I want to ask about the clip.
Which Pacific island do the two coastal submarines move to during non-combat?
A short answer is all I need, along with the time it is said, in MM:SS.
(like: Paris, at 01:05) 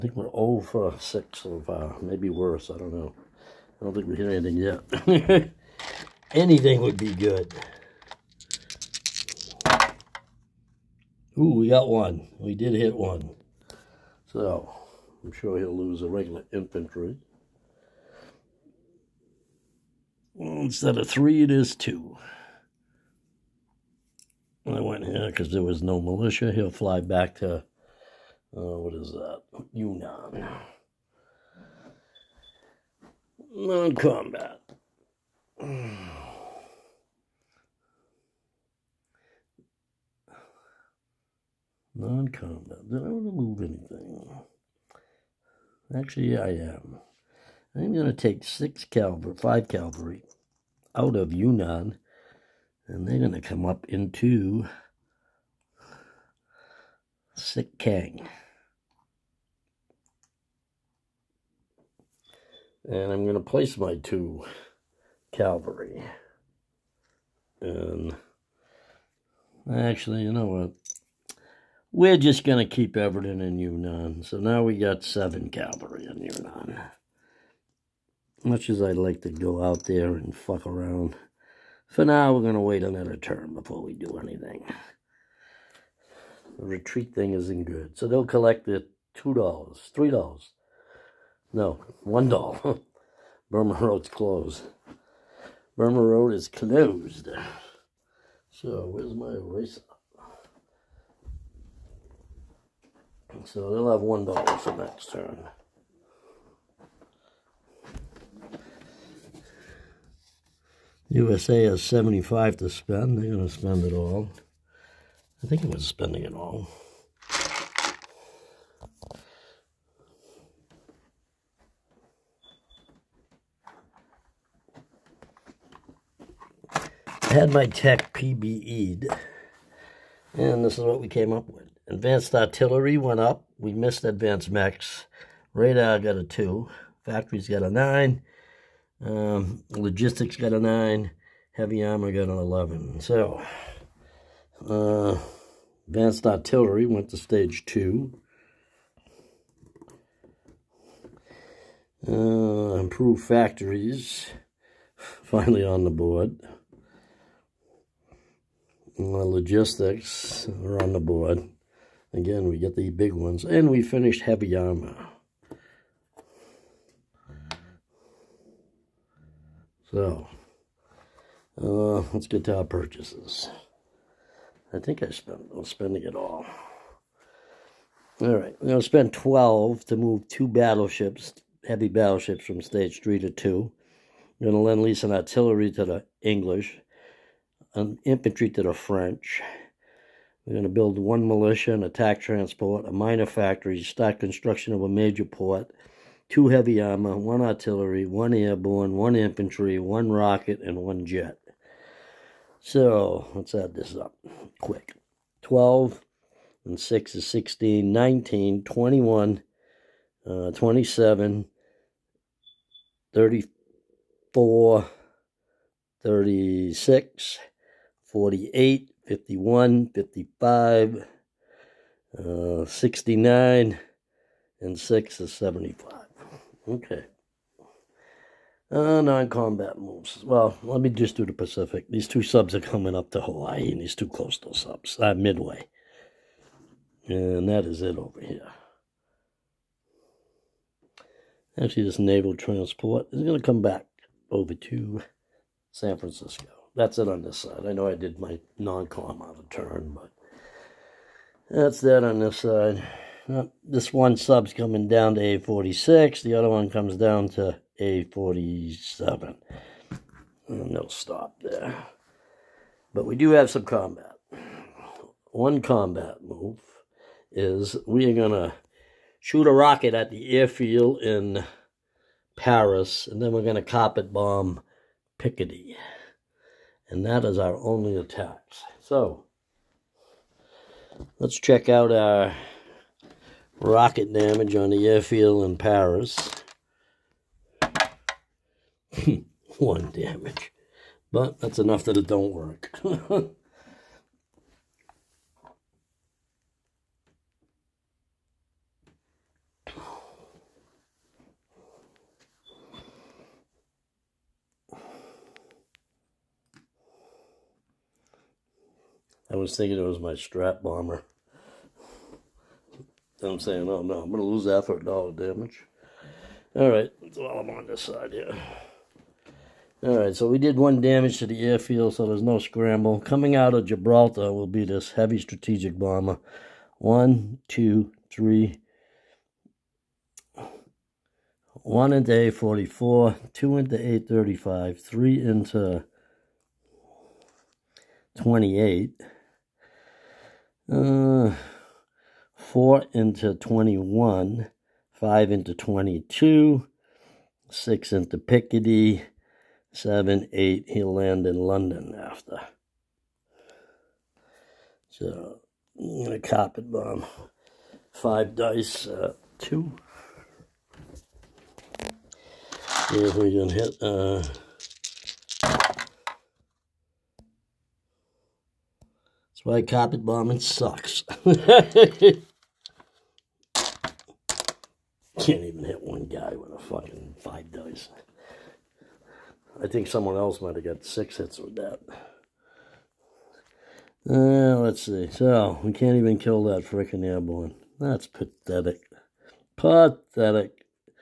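Midway, at 03:55.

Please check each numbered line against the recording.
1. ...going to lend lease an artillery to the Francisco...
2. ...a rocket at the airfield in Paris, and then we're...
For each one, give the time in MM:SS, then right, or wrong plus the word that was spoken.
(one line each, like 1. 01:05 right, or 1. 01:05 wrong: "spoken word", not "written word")
1. 03:04 wrong: "English", not "Francisco"
2. 04:29 right.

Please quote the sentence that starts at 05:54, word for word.
So, I'm going to carpet bomb.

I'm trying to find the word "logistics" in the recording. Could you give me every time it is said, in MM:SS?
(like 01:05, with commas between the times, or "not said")
02:19, 02:39.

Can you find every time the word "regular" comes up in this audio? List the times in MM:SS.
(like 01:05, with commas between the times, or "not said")
00:16.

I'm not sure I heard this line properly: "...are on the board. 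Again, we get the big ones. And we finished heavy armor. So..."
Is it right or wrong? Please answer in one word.
right.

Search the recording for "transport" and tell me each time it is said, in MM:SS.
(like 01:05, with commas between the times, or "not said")
03:12, 04:02.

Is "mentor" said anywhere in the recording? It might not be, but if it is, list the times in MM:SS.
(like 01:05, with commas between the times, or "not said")
not said.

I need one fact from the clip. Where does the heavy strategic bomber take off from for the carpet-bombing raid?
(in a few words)
Gibraltar.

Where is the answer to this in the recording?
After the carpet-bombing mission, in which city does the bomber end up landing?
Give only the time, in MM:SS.
05:51.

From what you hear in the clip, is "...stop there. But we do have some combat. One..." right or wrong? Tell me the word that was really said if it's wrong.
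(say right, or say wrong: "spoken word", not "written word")
right.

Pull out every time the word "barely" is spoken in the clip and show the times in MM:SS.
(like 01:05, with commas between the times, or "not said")
not said.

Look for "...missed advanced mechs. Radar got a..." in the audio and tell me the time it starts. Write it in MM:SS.
02:13.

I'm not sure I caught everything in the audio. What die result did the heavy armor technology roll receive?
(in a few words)
11.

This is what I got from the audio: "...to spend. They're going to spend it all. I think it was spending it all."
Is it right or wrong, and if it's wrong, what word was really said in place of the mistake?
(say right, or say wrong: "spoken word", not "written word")
right.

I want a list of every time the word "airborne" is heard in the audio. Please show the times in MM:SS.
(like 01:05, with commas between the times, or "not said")
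03:18, 06:27.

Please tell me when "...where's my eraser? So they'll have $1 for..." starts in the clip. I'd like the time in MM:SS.
01:38.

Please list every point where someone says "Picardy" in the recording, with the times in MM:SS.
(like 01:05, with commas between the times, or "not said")
04:35, 05:48.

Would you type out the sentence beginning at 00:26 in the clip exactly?
He'll fly back to, uh, what is that?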